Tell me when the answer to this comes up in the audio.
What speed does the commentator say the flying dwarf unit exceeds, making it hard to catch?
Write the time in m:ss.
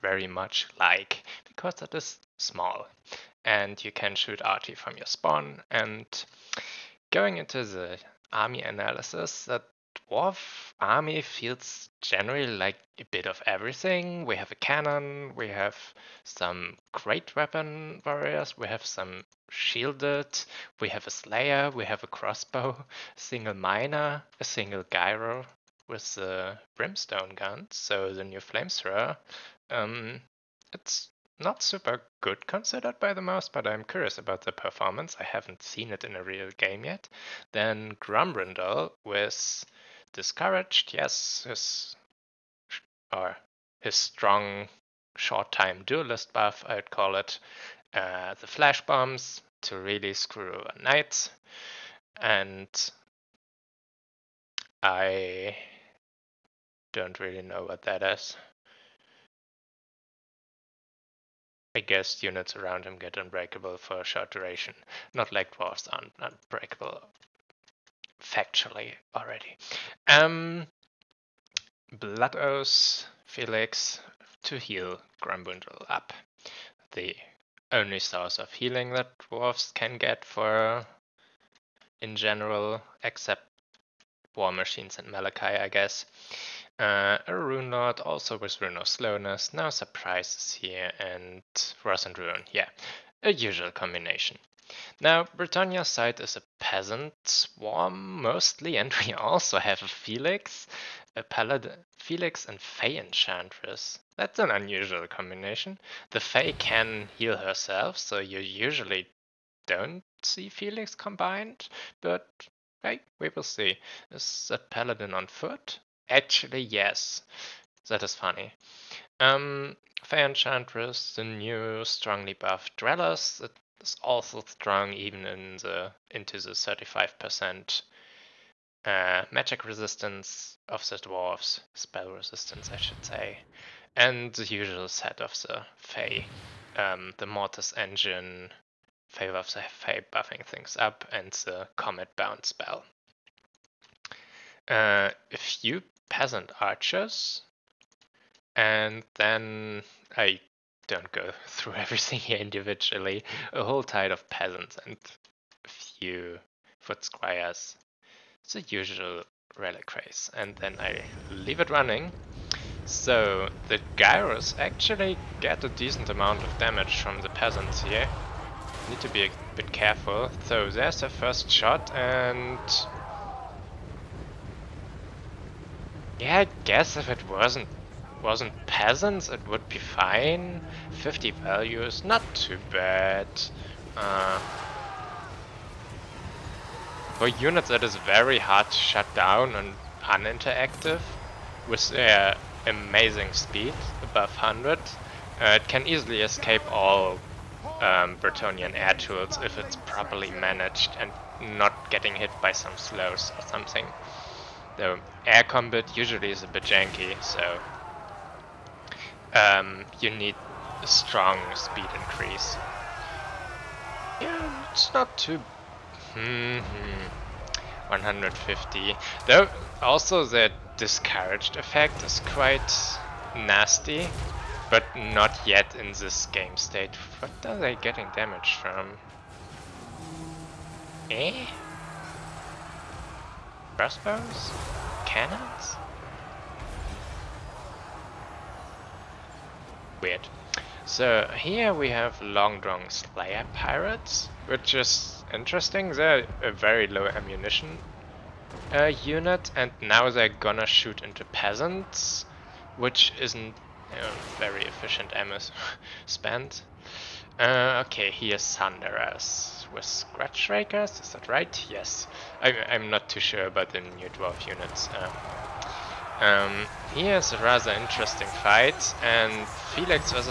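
3:14.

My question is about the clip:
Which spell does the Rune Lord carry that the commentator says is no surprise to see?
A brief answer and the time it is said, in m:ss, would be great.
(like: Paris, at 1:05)
Rune of Slowness, at 1:28.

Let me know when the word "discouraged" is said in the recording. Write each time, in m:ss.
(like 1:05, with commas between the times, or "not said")
0:40, 3:40.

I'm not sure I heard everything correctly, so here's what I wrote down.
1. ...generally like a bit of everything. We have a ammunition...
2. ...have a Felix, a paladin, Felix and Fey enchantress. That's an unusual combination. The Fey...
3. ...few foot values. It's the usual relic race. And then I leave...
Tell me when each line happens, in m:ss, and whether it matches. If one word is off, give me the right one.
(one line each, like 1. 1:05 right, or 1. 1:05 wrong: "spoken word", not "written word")
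1. 0:12 wrong: "cannon", not "ammunition"
2. 1:39 right
3. 2:35 wrong: "squires", not "values".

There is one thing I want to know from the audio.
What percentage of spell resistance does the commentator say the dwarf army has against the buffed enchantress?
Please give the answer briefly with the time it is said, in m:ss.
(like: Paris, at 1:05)
35%, at 2:06.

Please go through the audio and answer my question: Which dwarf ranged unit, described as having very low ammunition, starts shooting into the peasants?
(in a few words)
Long Drong Slayer Pirates.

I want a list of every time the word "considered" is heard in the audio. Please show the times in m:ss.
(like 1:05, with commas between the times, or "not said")
0:32.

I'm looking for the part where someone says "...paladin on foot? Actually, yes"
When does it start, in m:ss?
1:54.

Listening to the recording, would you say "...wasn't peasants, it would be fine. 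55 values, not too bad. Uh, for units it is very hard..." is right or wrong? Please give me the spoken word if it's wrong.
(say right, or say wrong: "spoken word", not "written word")
wrong: "50", not "55".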